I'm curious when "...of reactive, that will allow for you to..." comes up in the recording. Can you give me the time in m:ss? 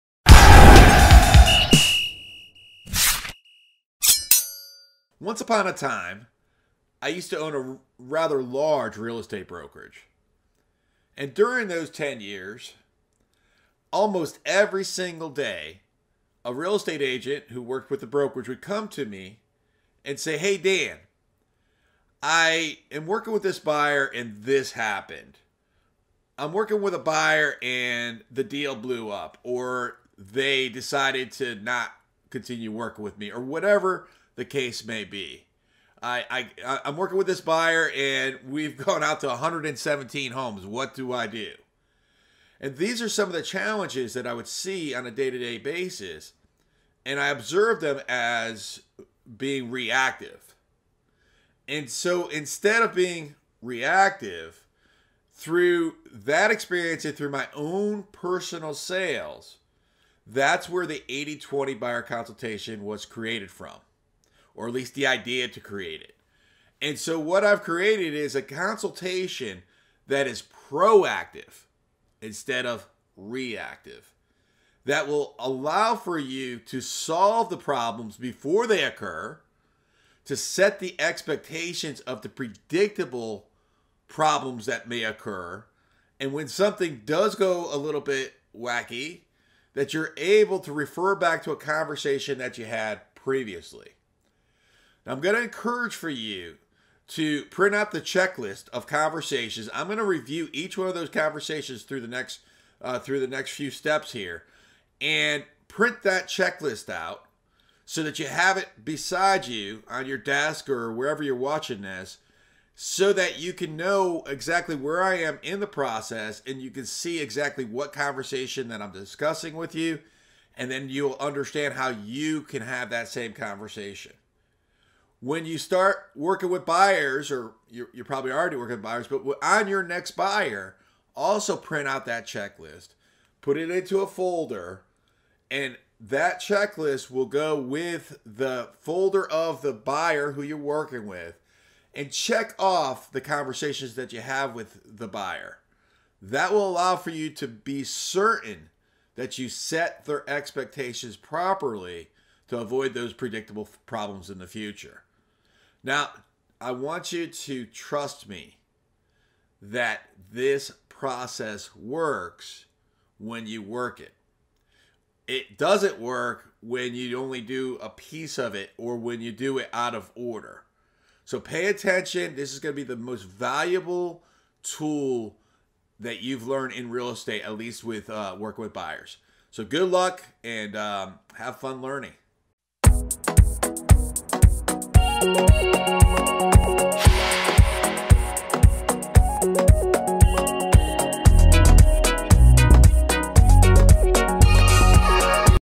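1:12.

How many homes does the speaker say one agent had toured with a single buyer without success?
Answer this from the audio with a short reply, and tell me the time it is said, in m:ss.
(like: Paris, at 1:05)
117, at 0:39.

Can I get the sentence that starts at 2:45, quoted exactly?
It doesn't work when you only do a piece of it or when you do it out of order.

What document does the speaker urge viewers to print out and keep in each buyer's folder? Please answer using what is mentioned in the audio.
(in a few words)
checklist of conversations.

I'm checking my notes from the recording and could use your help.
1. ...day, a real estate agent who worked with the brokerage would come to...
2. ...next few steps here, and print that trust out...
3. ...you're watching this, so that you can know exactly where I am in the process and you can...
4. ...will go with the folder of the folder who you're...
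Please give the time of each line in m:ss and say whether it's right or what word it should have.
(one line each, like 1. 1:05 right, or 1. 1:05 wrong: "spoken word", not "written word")
1. 0:15 right
2. 1:43 wrong: "checklist", not "trust"
3. 1:51 right
4. 2:17 wrong: "buyer", not "folder".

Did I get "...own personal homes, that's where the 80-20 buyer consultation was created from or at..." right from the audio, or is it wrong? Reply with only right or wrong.
wrong.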